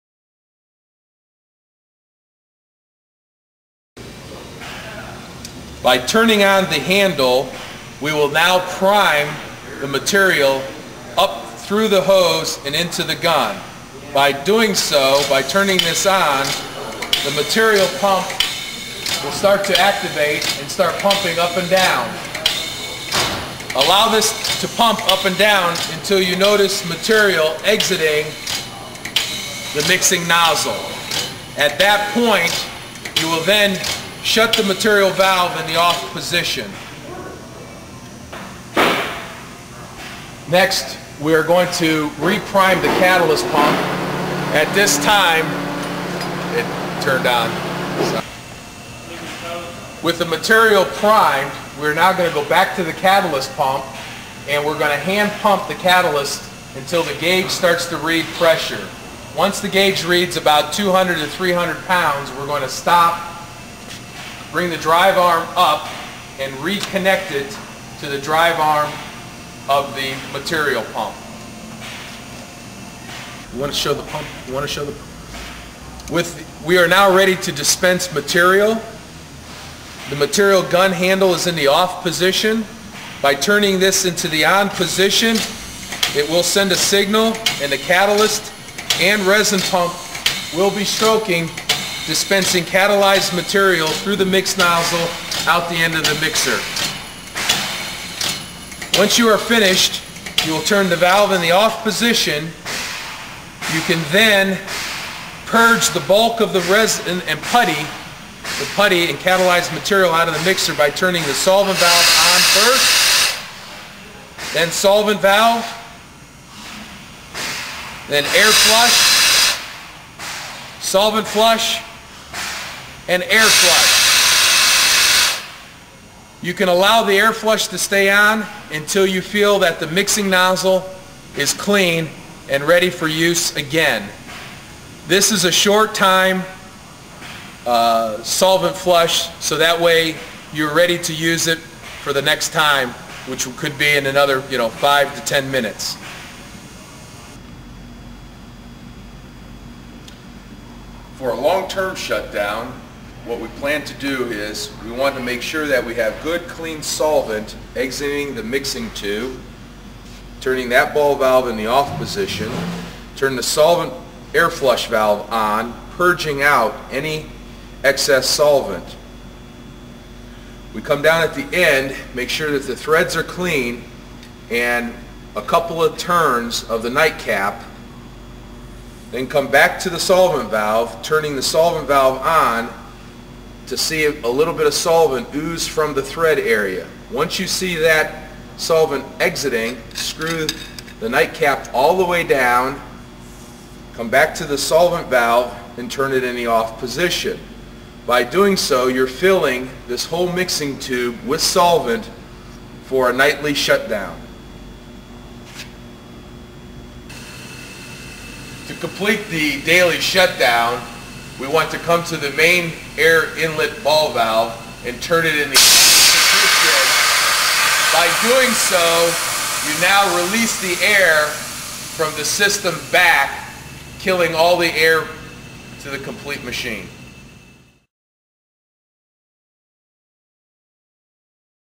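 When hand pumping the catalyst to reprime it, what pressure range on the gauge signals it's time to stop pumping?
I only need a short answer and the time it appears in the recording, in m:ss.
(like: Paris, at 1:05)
200 to 300 pounds, at 1:00.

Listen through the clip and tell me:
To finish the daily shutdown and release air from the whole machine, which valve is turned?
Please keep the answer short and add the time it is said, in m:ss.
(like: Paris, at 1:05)
Main air inlet ball valve, at 3:32.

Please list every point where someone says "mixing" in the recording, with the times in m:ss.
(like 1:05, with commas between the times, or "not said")
0:29, 2:09, 2:38, 3:20.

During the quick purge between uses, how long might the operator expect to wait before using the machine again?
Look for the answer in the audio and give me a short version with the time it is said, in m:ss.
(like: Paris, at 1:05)
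5 to 10 minutes, at 2:24.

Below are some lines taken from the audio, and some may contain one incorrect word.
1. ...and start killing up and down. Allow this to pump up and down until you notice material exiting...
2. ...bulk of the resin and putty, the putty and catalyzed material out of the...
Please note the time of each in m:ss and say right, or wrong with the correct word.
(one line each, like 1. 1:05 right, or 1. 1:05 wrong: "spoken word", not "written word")
1. 0:20 wrong: "pumping", not "killing"
2. 1:46 right.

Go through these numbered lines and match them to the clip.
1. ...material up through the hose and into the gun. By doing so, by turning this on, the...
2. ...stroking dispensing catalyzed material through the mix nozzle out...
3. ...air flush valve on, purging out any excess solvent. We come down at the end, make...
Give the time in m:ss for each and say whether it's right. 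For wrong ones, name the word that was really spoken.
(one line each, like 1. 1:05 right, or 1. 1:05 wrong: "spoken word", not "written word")
1. 0:09 right
2. 1:30 right
3. 2:44 right.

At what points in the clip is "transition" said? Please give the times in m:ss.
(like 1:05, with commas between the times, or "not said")
not said.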